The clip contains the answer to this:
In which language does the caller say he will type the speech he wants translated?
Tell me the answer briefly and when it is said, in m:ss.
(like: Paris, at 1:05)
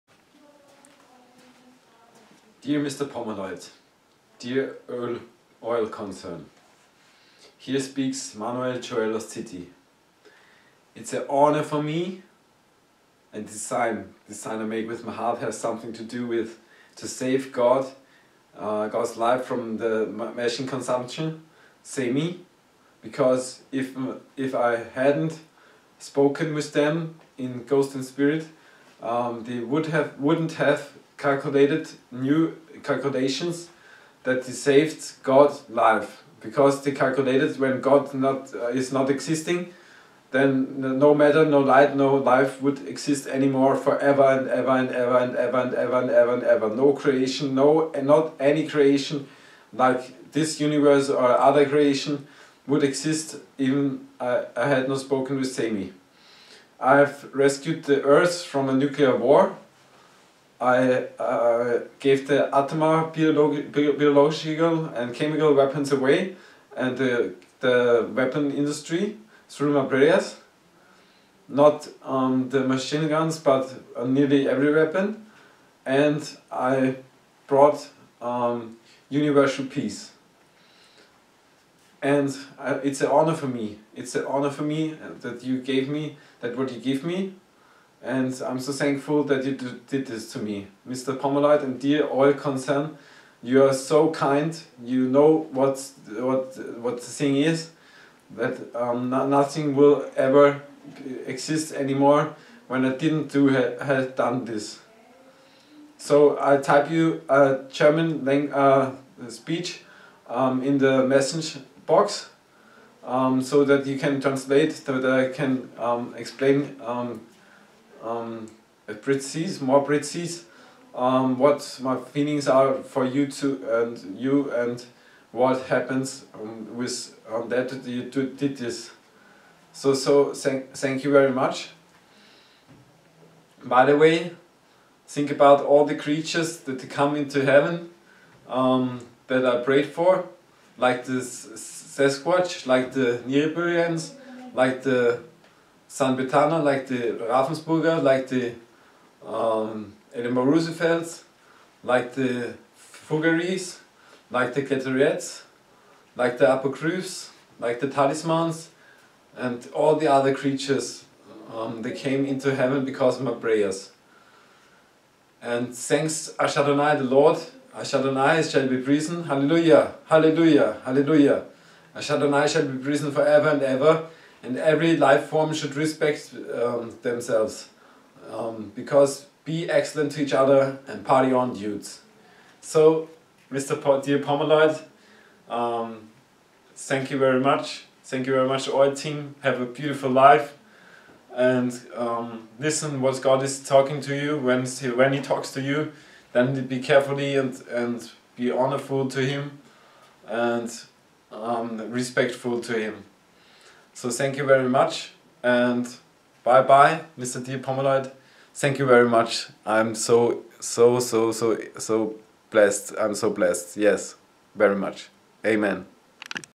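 German, at 1:47.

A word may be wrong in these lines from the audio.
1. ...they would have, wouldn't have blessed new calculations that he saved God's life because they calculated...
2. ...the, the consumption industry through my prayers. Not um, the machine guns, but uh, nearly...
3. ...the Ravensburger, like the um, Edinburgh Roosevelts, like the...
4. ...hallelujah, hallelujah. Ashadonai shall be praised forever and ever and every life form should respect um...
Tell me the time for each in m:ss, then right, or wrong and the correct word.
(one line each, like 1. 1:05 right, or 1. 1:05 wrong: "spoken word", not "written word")
1. 0:29 wrong: "calculated", not "blessed"
2. 1:06 wrong: "weapon", not "consumption"
3. 2:26 right
4. 2:50 right.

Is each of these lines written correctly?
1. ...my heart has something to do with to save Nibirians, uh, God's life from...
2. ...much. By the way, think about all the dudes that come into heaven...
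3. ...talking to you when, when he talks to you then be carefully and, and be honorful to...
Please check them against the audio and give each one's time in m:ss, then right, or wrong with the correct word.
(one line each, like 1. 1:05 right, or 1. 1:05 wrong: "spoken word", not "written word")
1. 0:15 wrong: "God", not "Nibirians"
2. 2:11 wrong: "creatures", not "dudes"
3. 3:13 right.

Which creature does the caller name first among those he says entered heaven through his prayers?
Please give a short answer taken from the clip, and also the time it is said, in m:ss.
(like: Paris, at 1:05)
Sasquatch, at 2:21.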